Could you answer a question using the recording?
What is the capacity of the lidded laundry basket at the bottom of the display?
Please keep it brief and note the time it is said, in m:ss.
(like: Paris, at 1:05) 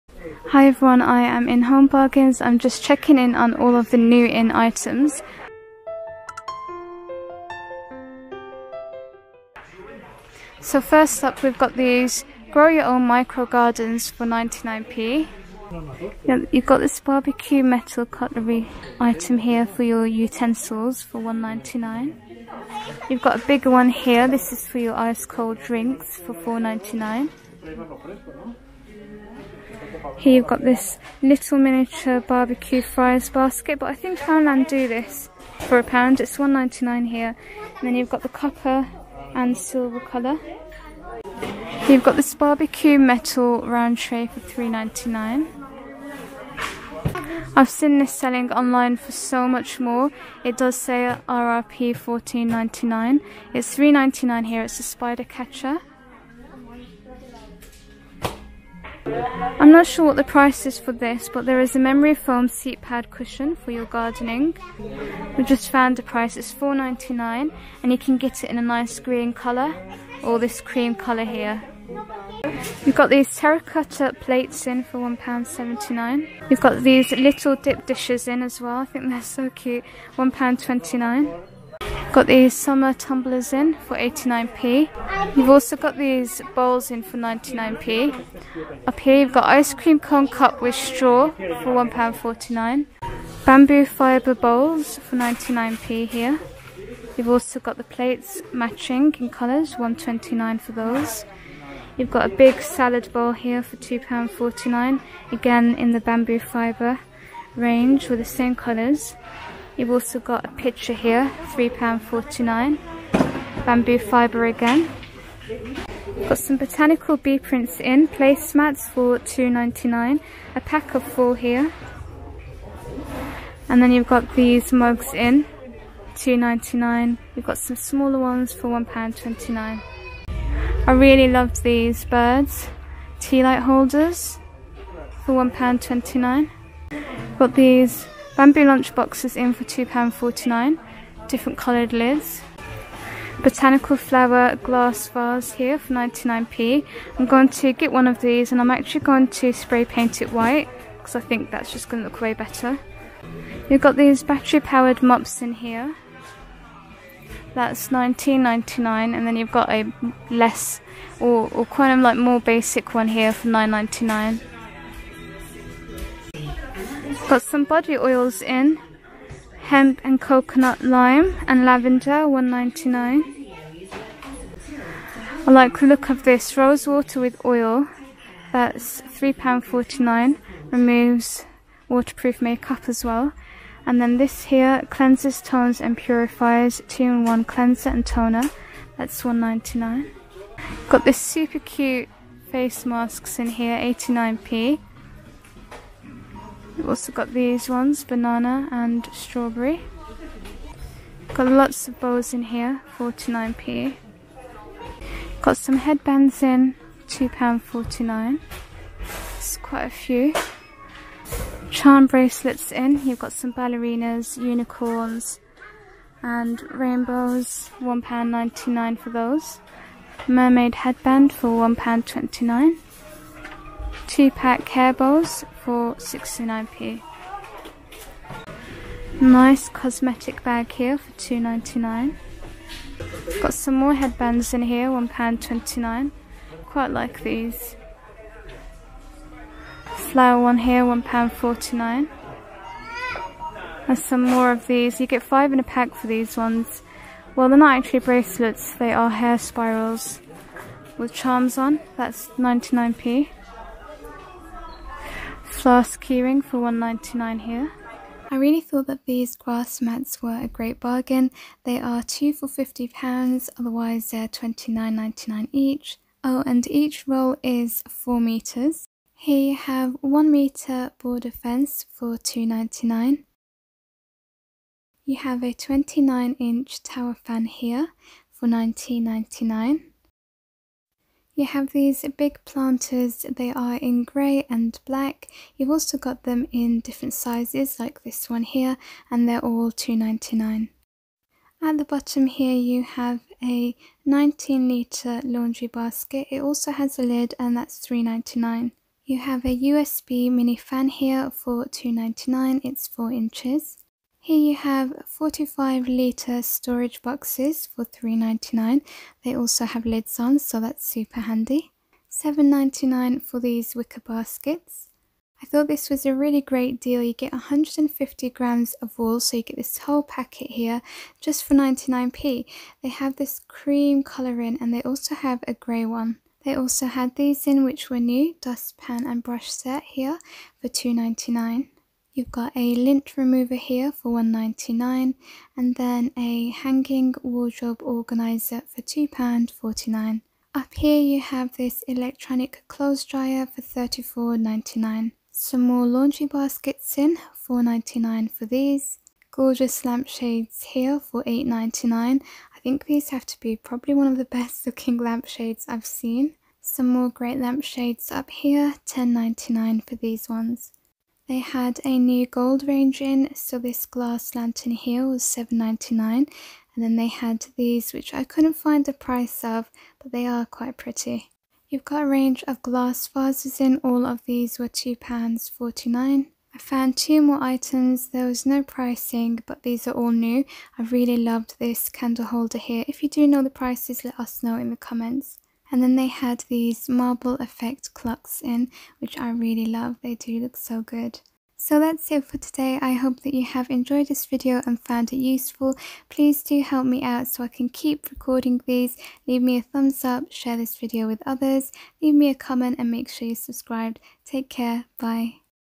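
19 litres, at 4:54.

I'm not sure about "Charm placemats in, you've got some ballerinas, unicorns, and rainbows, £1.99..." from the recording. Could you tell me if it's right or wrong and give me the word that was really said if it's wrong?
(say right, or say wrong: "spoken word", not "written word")
wrong: "bracelets", not "placemats".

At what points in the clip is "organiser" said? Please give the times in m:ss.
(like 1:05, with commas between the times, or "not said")
5:37.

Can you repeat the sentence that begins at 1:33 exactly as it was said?
Bamboo fibre bowls for 99p here.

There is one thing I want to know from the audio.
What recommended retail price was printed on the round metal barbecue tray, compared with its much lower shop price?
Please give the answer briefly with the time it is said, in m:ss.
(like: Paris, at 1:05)
£14.99, at 0:51.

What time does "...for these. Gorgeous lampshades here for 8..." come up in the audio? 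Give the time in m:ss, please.
5:48.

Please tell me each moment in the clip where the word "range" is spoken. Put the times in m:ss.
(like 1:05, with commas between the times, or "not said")
1:47, 6:02, 6:12.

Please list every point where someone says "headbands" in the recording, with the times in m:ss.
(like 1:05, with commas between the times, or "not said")
3:25, 3:40, 3:53.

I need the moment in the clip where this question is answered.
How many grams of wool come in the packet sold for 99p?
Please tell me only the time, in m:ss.
5:17.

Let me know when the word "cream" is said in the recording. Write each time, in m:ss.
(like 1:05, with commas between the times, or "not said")
1:10, 1:29, 5:23.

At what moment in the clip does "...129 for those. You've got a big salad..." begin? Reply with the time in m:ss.
1:39.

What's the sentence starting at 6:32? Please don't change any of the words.
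I hope that you have enjoyed this video and found it useful.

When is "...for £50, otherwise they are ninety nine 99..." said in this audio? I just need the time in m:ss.
4:22.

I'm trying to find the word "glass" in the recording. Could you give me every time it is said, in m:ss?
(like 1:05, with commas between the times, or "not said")
2:24, 6:03, 6:12.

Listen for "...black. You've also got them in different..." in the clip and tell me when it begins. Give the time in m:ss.
4:44.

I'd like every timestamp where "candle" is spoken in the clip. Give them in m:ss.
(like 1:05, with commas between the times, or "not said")
6:21.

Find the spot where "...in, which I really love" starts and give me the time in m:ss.
6:28.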